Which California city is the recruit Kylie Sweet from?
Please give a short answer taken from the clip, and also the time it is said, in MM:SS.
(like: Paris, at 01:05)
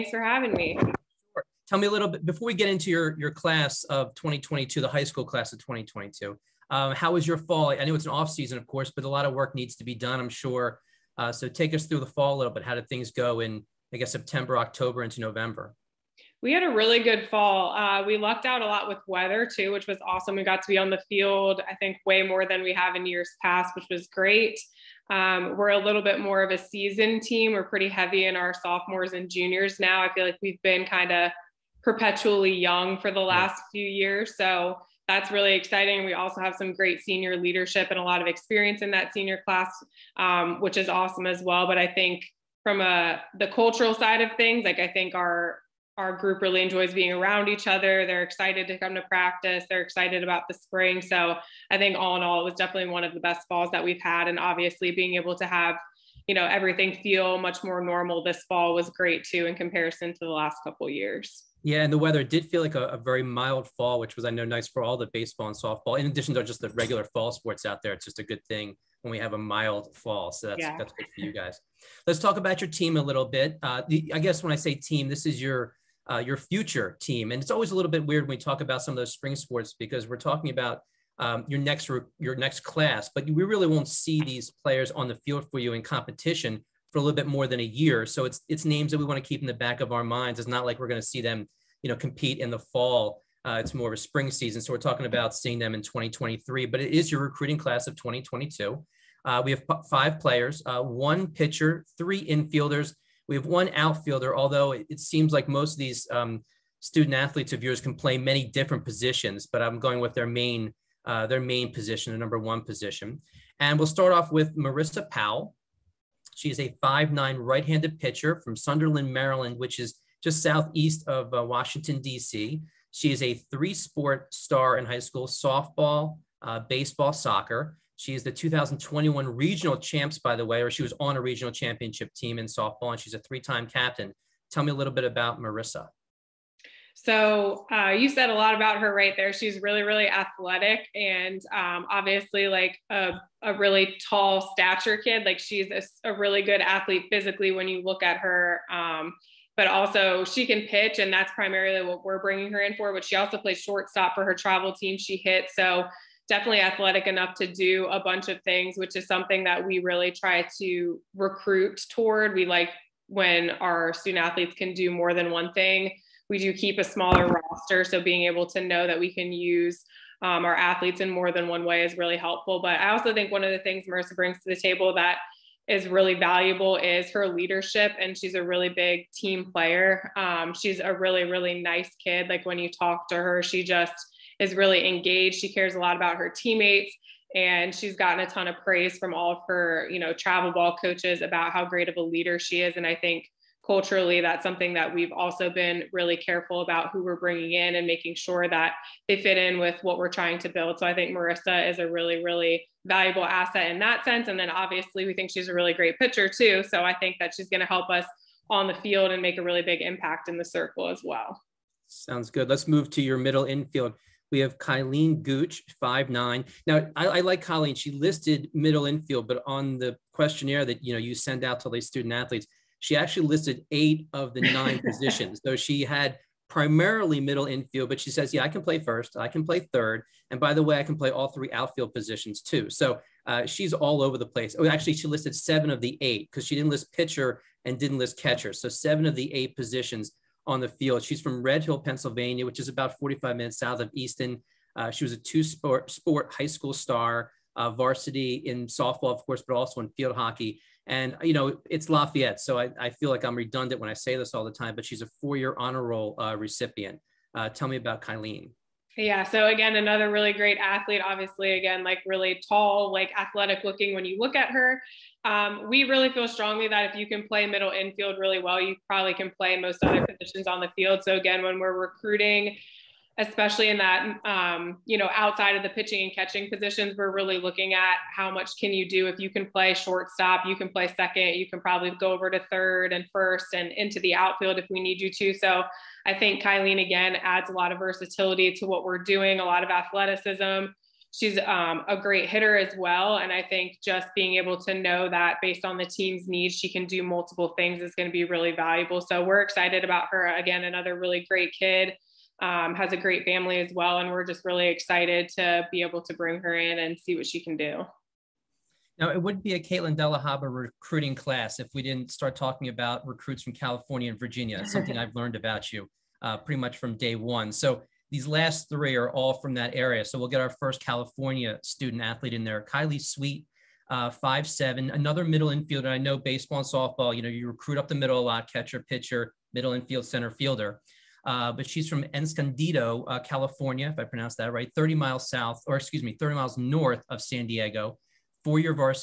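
Escondido, at 05:32.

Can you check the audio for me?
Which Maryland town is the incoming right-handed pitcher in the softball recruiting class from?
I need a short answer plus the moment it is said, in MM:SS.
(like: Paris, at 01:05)
Sunderland, at 01:58.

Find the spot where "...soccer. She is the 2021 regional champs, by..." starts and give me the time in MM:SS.
02:07.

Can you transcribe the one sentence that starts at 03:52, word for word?
So uh, she's all over the place.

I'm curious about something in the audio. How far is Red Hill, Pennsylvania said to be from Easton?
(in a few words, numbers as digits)
45 minutes.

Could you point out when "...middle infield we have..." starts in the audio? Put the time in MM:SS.
03:33.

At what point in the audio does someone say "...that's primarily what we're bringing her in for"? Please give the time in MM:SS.
02:31.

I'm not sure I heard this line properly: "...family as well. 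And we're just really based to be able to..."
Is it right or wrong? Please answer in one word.
wrong.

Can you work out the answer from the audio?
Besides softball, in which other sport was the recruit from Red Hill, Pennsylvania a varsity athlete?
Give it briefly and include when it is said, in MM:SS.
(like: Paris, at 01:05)
Field hockey, at 04:09.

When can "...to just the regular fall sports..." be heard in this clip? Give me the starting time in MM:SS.
01:06.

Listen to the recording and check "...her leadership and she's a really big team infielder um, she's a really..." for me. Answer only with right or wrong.
wrong.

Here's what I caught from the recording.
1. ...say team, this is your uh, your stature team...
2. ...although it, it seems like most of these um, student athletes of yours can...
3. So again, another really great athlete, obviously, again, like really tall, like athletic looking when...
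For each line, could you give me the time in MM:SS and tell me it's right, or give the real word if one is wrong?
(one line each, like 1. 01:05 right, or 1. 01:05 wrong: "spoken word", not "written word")
1. 01:14 wrong: "future", not "stature"
2. 01:44 right
3. 04:19 right.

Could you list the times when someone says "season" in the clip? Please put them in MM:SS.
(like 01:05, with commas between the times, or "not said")
00:08, 00:26, 01:34.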